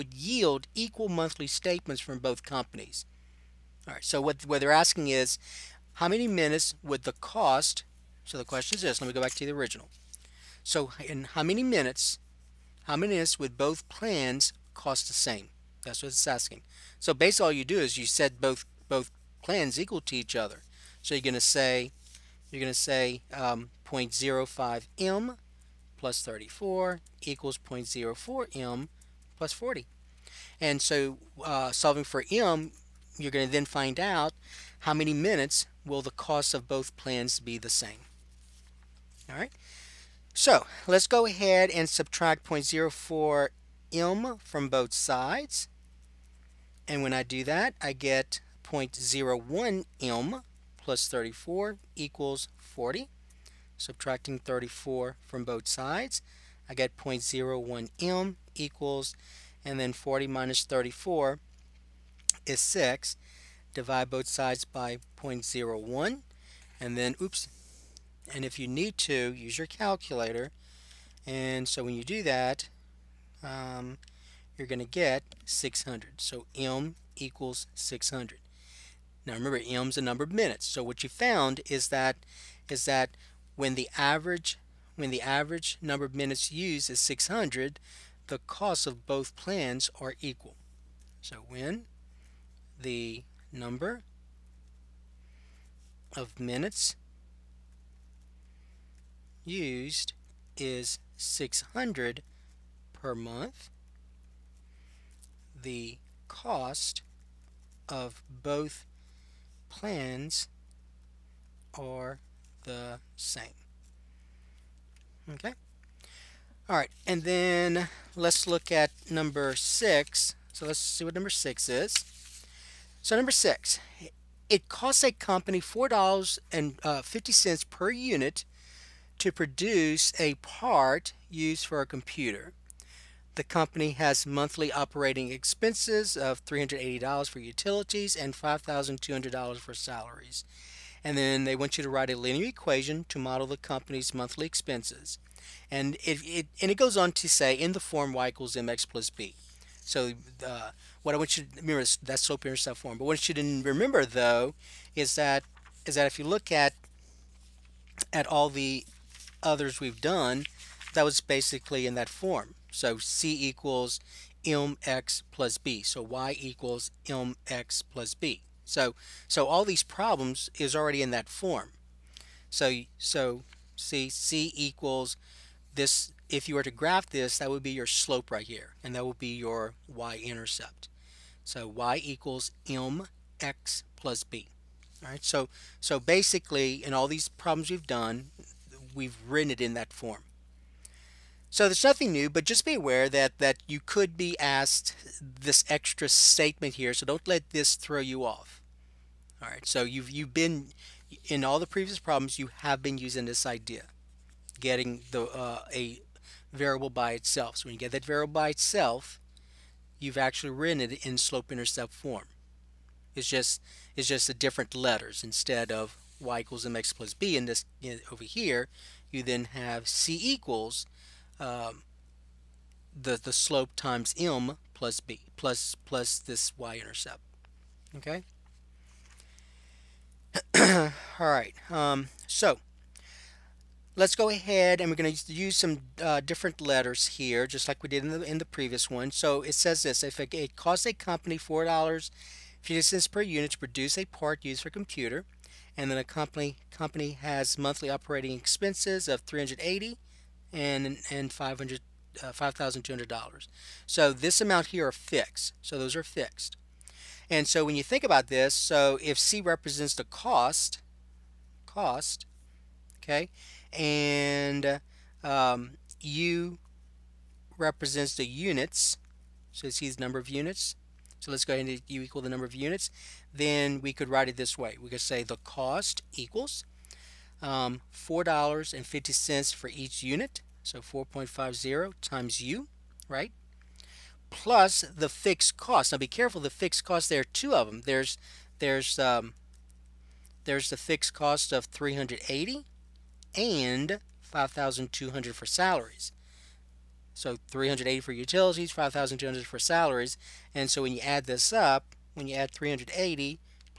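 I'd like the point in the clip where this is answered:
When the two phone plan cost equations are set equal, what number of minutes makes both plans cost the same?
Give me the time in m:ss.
1:16.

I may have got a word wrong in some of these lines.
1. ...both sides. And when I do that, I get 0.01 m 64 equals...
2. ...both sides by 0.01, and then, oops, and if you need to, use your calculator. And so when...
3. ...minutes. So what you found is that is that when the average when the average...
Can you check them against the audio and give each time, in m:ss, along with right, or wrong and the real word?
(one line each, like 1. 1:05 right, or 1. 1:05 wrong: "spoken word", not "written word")
1. 0:44 wrong: "34", not "64"
2. 1:04 right
3. 1:20 right.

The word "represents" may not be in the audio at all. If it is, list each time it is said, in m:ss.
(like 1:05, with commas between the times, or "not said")
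4:19, 4:27.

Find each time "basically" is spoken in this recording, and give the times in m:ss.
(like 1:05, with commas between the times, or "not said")
0:17, 2:41, 3:05.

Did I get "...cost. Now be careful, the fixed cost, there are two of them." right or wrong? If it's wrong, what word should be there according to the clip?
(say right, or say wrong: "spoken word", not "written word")
right.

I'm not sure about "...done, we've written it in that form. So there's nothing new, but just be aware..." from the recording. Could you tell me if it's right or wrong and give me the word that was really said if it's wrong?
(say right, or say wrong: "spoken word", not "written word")
right.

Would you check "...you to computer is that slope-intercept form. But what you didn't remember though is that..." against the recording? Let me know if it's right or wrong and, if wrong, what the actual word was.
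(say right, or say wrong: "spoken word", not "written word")
wrong: "remember", not "computer".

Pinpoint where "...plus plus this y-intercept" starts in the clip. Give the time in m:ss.
3:45.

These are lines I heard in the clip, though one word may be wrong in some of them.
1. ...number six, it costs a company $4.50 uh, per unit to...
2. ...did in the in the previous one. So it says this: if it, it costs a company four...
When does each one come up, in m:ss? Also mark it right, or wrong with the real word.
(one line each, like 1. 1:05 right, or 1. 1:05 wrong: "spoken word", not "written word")
1. 2:03 right
2. 3:57 right.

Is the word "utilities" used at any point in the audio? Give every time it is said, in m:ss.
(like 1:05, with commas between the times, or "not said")
2:17, 4:58.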